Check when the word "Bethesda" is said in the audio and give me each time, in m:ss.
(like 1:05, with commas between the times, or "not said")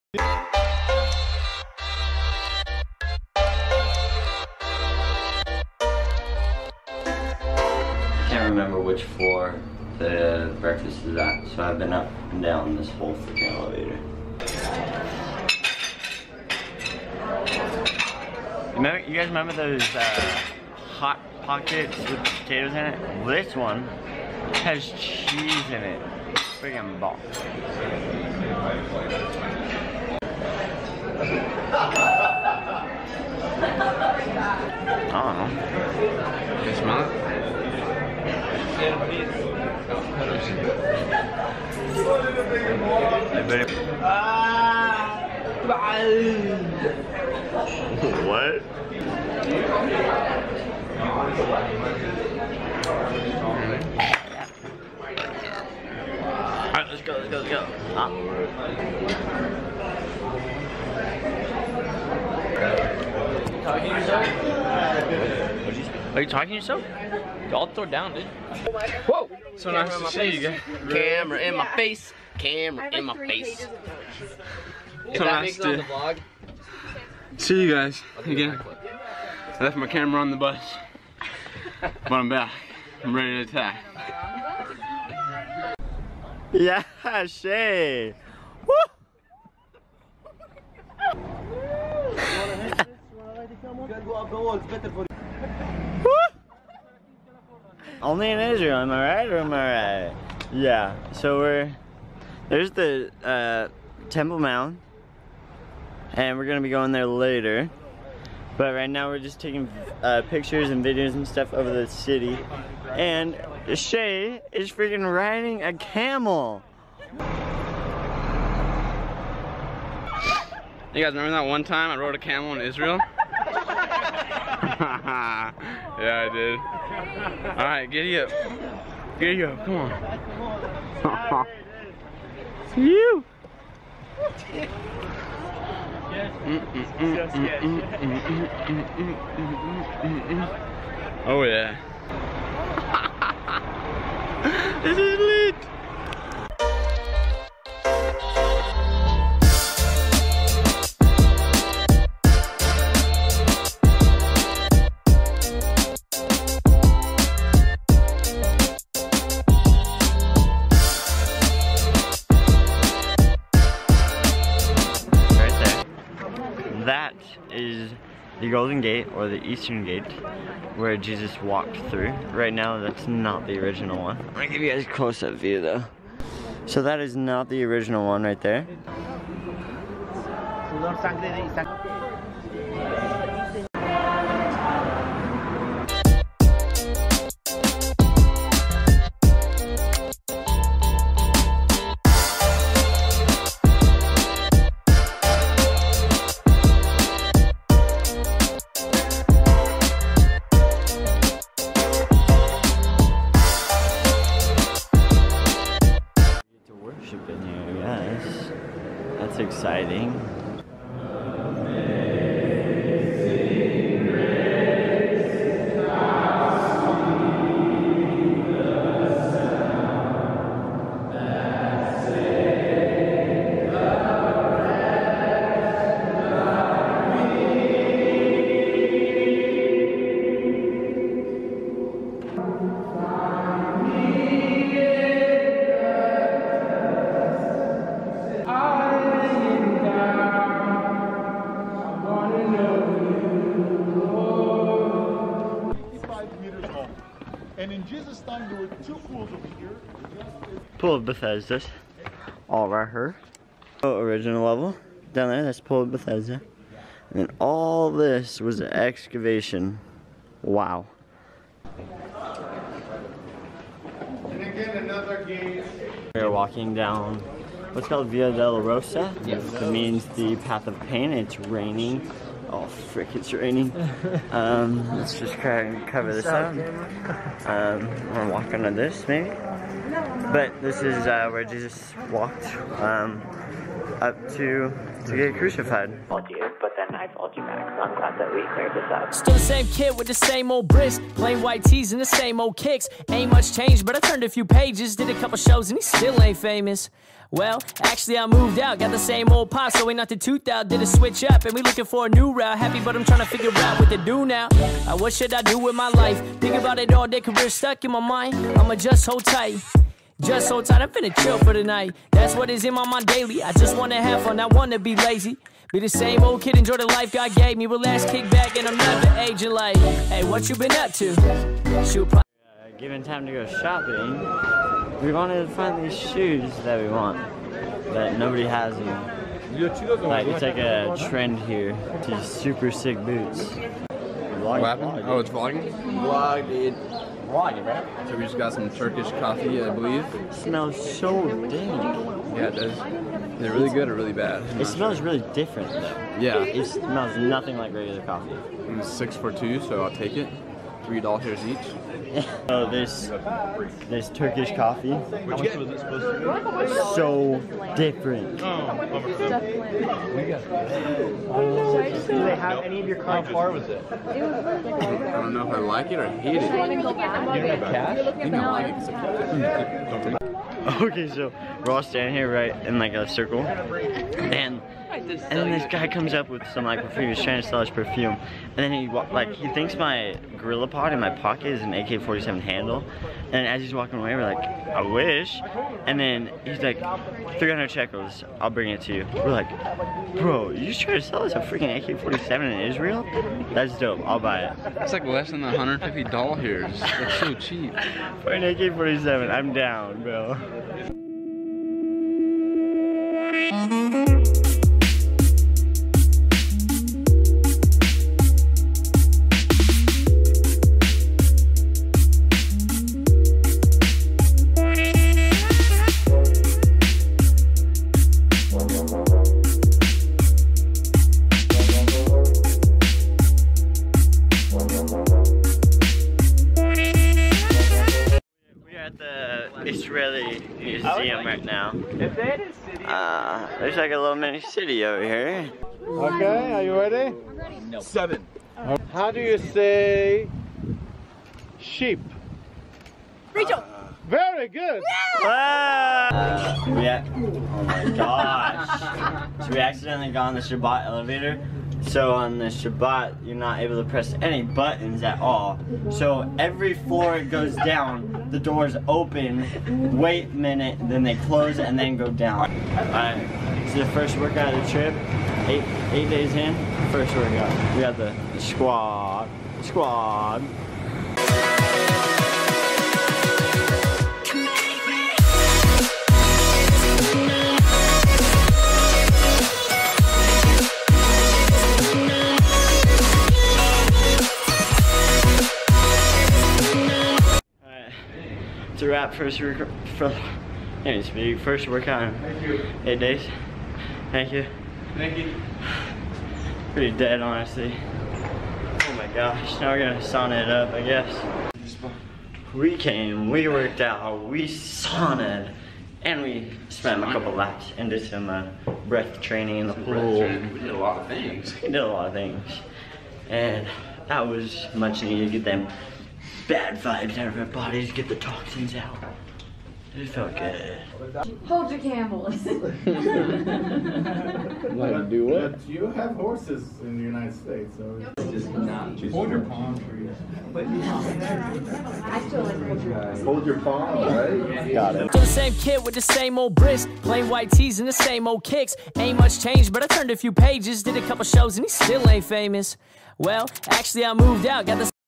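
4:11, 4:15.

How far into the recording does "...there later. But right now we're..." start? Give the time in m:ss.
1:46.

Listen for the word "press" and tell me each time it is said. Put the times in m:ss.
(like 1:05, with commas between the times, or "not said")
7:33.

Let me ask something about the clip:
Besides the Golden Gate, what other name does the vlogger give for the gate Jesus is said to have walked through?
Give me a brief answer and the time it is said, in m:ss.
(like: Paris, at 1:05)
Eastern Gate, at 2:49.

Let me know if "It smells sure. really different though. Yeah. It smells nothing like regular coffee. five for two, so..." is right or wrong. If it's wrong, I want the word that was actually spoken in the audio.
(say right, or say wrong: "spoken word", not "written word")
wrong: "six", not "five".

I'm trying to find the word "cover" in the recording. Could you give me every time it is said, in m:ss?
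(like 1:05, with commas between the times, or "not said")
4:35.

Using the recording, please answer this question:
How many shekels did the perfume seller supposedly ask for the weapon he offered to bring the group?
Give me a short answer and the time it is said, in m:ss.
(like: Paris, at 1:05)
300, at 6:27.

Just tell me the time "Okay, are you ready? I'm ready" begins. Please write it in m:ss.
7:15.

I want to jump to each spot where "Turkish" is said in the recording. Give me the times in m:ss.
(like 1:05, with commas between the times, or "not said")
5:38, 5:54.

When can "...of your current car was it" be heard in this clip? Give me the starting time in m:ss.
6:02.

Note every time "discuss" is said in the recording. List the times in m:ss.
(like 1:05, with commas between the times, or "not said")
not said.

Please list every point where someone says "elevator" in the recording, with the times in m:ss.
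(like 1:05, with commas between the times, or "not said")
0:13, 7:30.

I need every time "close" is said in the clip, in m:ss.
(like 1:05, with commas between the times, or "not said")
2:54, 7:41.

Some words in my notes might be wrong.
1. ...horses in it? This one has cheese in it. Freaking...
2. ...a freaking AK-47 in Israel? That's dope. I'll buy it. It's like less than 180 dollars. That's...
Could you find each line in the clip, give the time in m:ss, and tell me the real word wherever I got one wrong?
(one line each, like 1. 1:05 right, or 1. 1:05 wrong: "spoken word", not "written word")
1. 0:22 wrong: "potatoes", not "horses"
2. 6:31 wrong: "150", not "180".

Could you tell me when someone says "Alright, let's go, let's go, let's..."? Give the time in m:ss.
0:56.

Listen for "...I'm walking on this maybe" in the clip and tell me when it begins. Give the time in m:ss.
4:38.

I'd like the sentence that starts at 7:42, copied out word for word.
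Alright, this is the first workout of the trip.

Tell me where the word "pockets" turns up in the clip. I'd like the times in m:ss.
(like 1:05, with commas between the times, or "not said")
0:21, 6:21.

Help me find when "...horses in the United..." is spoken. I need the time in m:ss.
8:46.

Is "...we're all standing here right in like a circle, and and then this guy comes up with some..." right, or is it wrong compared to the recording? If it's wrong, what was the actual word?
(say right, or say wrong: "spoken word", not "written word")
right.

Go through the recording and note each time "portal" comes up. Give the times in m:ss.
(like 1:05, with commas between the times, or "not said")
not said.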